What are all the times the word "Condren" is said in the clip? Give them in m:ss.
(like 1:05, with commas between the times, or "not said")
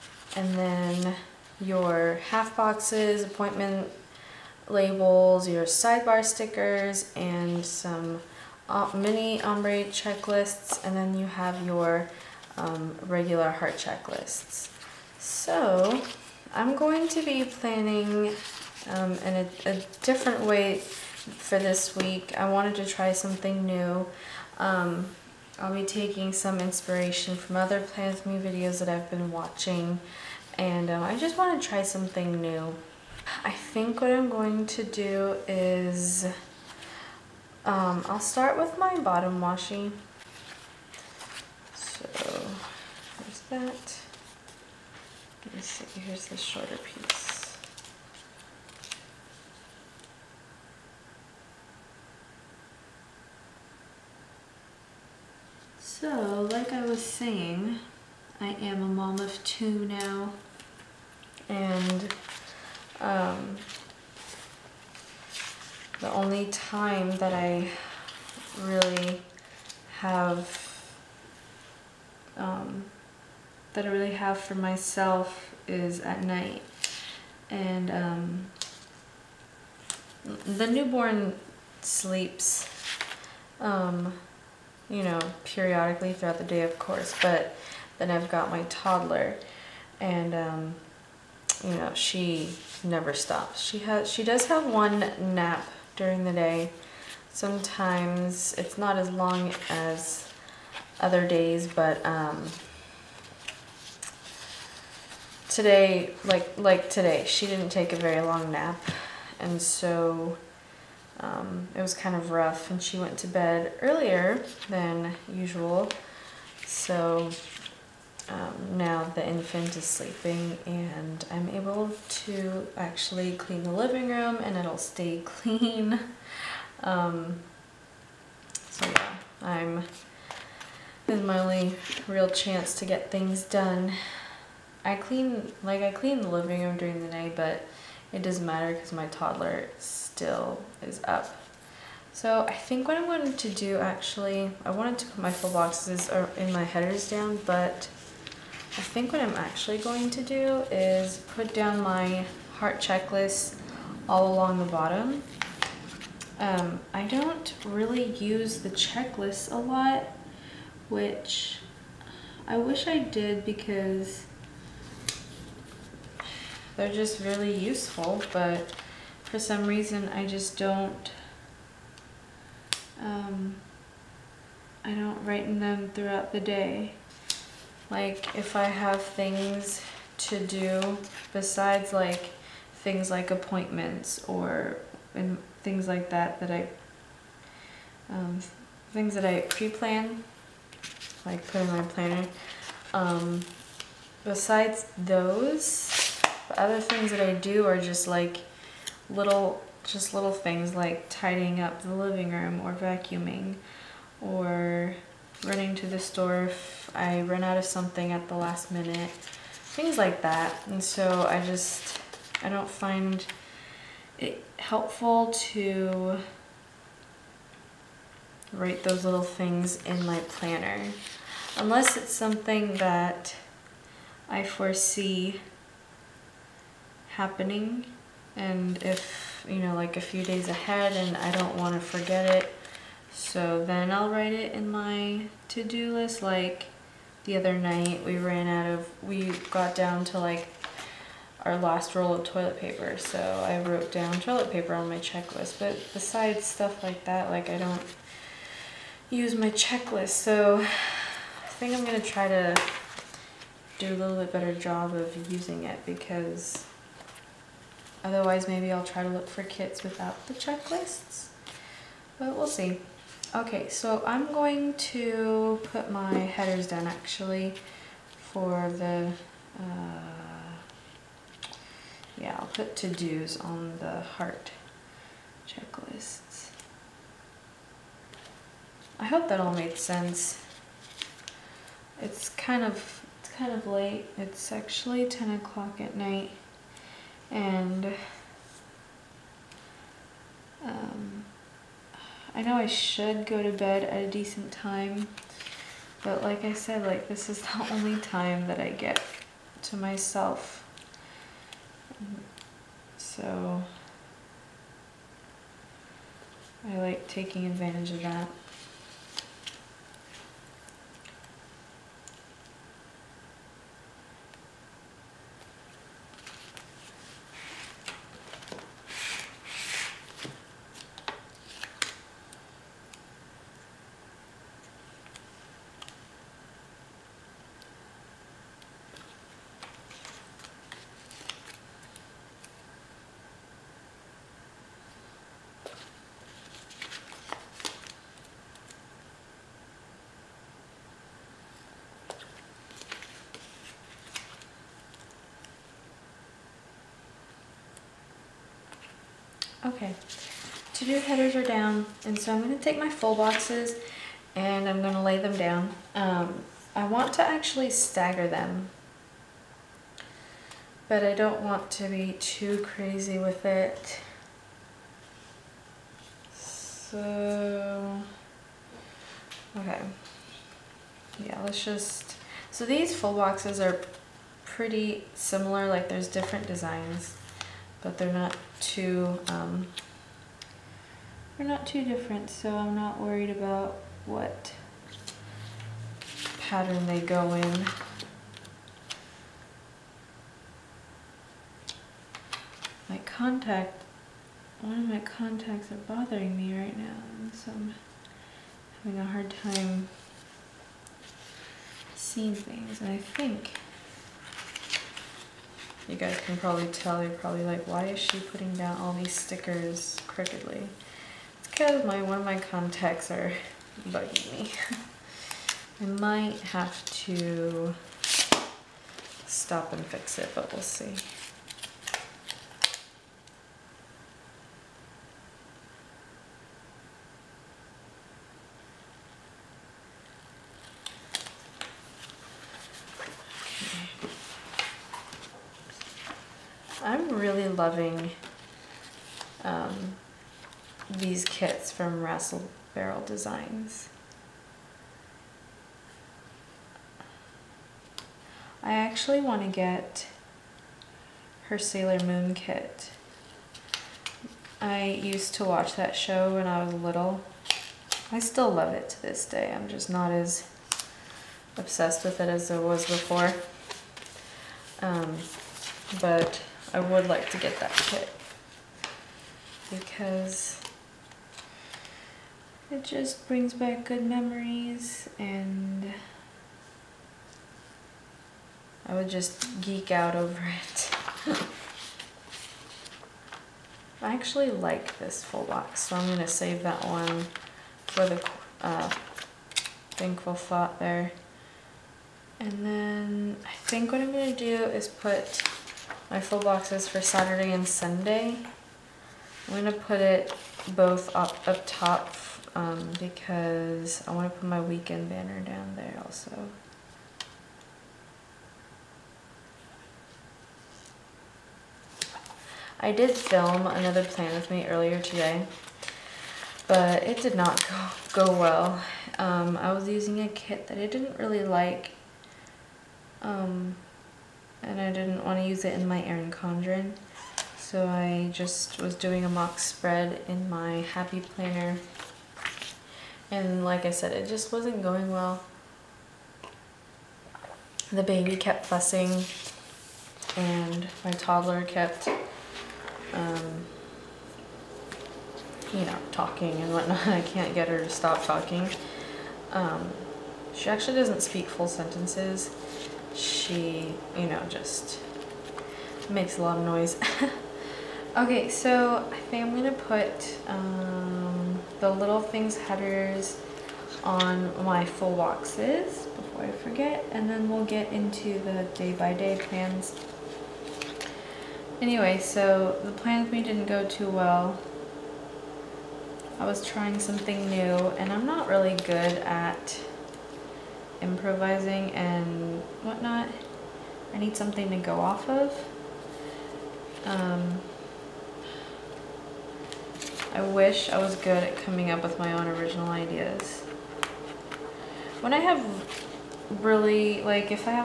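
8:46.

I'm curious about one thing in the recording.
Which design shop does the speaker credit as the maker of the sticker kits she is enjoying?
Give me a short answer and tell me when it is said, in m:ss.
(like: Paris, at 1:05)
Russell Barrel Designs, at 7:22.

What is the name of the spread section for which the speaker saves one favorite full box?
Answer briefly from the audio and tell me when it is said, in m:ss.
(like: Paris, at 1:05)
thankful thought, at 8:09.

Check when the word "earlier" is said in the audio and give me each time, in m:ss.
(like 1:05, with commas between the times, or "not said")
1:53, 8:34.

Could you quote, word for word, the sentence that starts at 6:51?
It's because my one of my contacts are bugging me.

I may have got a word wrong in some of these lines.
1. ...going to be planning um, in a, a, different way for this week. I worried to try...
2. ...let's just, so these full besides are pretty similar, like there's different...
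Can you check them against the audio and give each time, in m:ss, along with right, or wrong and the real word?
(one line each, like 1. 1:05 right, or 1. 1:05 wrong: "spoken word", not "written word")
1. 0:16 wrong: "wanted", not "worried"
2. 6:11 wrong: "boxes", not "besides".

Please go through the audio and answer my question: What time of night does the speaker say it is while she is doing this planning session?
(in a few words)
10 o'clock.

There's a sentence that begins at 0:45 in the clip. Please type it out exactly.
Let me see, here's the shorter piece.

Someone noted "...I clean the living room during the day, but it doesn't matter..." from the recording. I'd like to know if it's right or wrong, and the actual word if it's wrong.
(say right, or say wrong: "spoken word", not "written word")
right.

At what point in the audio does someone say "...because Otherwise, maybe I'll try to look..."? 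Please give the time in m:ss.
4:15.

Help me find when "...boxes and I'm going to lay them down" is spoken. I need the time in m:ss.
5:53.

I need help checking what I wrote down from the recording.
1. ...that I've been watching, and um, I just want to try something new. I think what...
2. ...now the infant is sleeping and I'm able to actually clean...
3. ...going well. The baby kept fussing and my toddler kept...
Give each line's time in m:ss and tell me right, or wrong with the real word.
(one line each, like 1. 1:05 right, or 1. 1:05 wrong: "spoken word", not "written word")
1. 0:28 right
2. 1:58 right
3. 8:54 right.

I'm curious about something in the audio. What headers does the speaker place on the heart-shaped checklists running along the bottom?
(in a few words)
to-dos.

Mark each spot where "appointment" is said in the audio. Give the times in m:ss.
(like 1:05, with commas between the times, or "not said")
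0:03, 3:03.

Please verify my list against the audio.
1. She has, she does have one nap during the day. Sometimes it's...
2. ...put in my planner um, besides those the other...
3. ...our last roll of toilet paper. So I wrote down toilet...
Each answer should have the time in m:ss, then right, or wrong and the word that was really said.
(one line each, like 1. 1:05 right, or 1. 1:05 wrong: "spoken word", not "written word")
1. 1:33 right
2. 3:11 right
3. 4:01 right.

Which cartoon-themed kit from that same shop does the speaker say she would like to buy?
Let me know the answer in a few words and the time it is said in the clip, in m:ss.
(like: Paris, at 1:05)
Sailor Moon, at 7:31.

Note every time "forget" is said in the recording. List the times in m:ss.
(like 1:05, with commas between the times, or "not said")
3:51, 9:26.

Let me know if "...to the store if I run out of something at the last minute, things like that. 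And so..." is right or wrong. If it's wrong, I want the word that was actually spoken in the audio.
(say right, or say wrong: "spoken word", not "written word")
right.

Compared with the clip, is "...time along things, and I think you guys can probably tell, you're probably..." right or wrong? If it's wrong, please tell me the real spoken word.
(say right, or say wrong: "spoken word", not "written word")
wrong: "seeing", not "along".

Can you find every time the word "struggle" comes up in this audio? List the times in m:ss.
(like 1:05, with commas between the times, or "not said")
not said.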